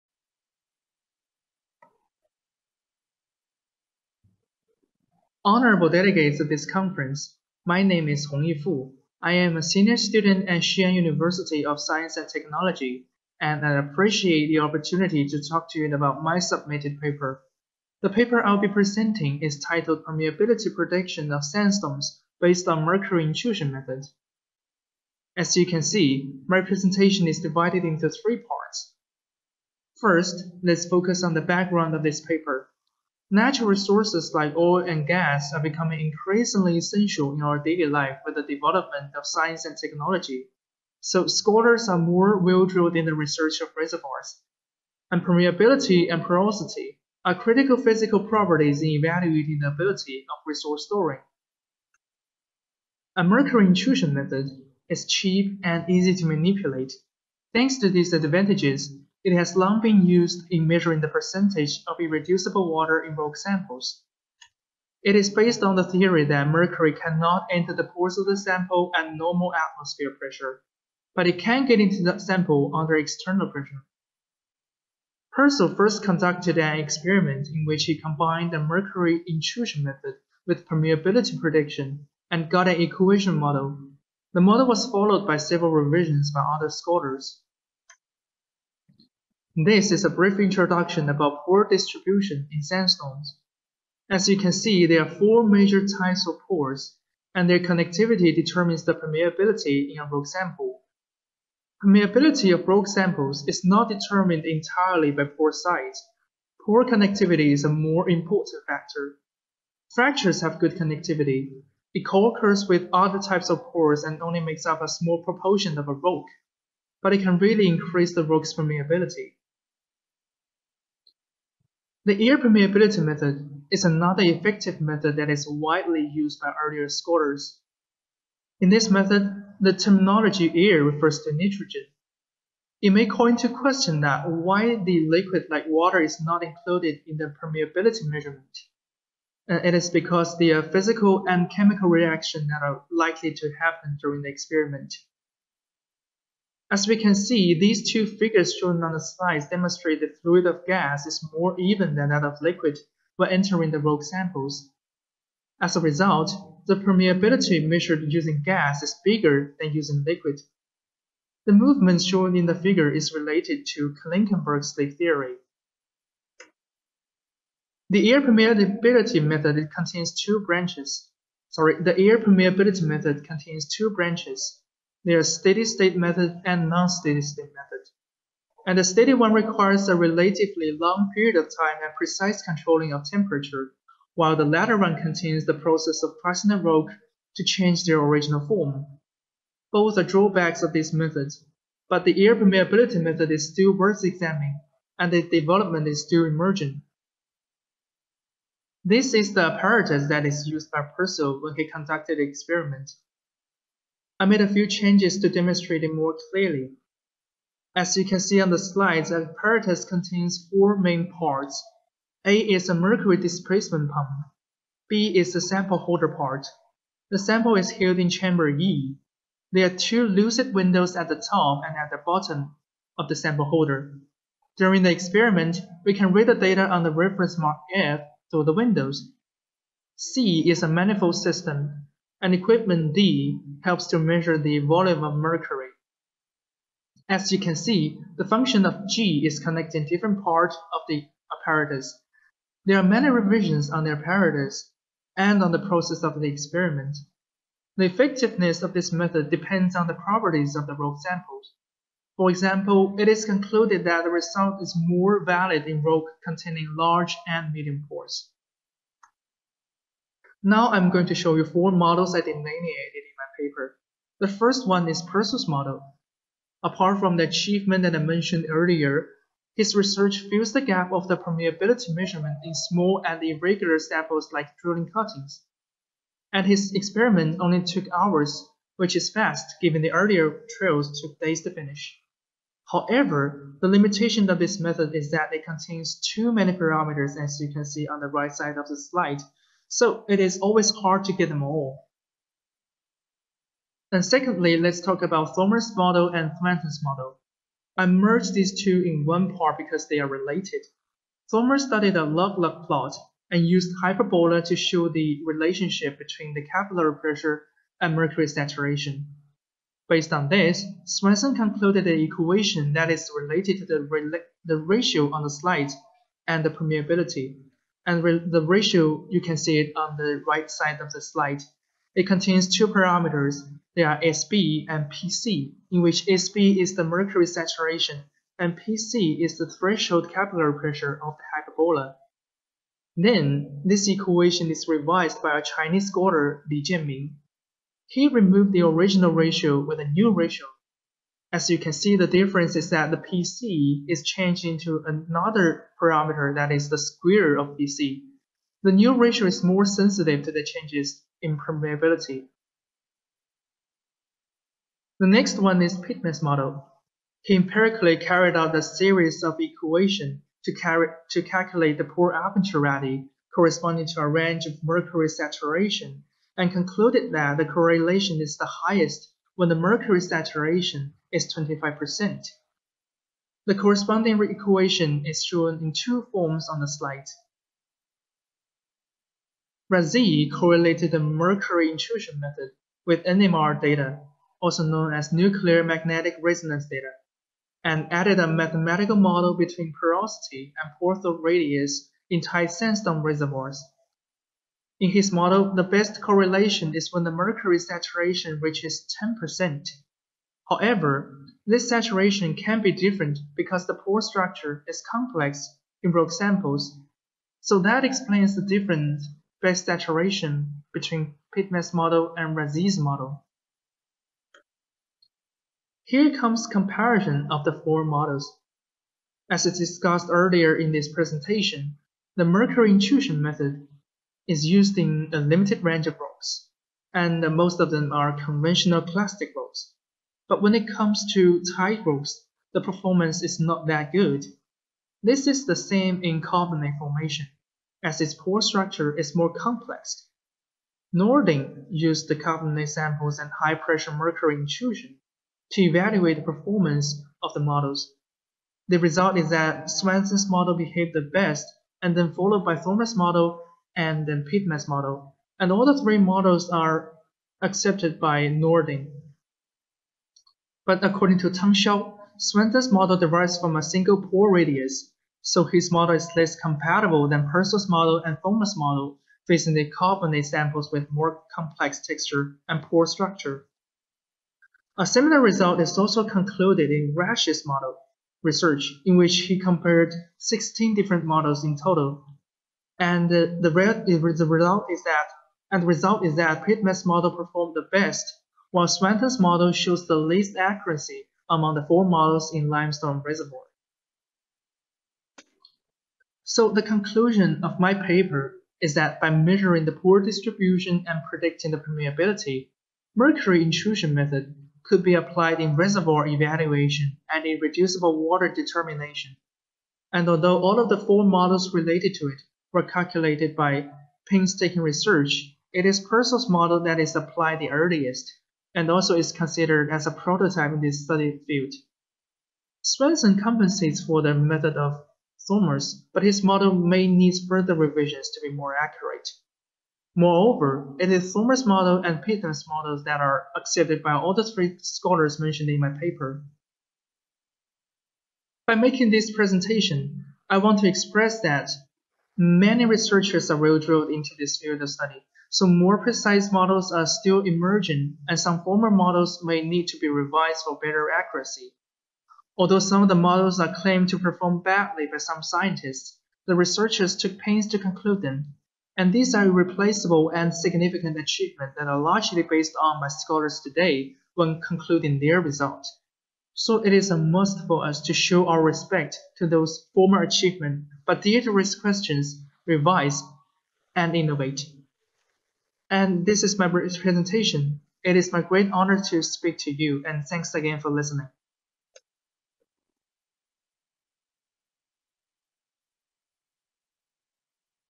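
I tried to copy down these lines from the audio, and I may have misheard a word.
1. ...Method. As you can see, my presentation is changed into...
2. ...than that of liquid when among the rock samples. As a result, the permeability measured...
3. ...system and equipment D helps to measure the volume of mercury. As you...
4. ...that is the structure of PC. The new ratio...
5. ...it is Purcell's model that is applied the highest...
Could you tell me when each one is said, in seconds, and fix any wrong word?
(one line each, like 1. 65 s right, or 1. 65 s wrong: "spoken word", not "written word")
1. 23 s wrong: "divided", not "changed"
2. 151 s wrong: "entering", not "among"
3. 231 s right
4. 346 s wrong: "square", not "structure"
5. 515 s wrong: "earliest", not "highest".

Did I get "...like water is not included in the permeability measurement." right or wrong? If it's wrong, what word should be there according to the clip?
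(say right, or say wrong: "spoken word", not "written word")
right.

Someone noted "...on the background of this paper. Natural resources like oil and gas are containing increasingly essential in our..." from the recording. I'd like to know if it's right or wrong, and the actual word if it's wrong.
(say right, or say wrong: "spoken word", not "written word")
wrong: "becoming", not "containing".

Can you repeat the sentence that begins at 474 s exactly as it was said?
A similar result is also concluded in Rash's model research, in which he compared 16 different models in total.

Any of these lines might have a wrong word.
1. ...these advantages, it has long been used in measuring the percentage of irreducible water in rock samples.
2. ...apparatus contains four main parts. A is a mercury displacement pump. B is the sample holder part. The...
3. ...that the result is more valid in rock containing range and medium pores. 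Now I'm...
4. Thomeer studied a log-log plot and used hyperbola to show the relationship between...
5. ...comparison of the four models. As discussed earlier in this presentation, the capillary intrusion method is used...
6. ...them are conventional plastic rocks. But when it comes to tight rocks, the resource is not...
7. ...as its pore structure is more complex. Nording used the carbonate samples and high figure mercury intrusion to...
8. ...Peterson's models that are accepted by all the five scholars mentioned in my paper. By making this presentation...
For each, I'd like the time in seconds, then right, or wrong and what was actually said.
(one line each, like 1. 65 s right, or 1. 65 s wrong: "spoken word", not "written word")
1. 57 s right
2. 209 s right
3. 253 s wrong: "large", not "range"
4. 301 s right
5. 416 s wrong: "mercury", not "capillary"
6. 427 s wrong: "performance", not "resource"
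7. 437 s wrong: "pressure", not "figure"
8. 532 s wrong: "three", not "five".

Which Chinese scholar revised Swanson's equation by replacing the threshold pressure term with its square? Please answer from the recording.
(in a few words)
Li Jianming.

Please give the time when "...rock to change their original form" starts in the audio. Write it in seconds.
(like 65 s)
186 s.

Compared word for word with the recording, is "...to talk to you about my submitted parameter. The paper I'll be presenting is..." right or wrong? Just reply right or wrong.
wrong.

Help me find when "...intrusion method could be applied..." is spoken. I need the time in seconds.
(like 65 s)
503 s.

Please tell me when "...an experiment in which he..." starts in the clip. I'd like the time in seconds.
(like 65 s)
76 s.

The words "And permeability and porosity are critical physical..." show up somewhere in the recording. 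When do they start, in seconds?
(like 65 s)
45 s.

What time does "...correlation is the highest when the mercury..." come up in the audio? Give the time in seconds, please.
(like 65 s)
367 s.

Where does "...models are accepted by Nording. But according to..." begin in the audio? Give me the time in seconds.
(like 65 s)
455 s.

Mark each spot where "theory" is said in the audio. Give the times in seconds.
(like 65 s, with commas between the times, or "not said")
65 s, 164 s.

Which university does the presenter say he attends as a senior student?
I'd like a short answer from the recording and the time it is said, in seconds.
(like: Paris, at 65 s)
Xi'an University of Science and Technology, at 10 s.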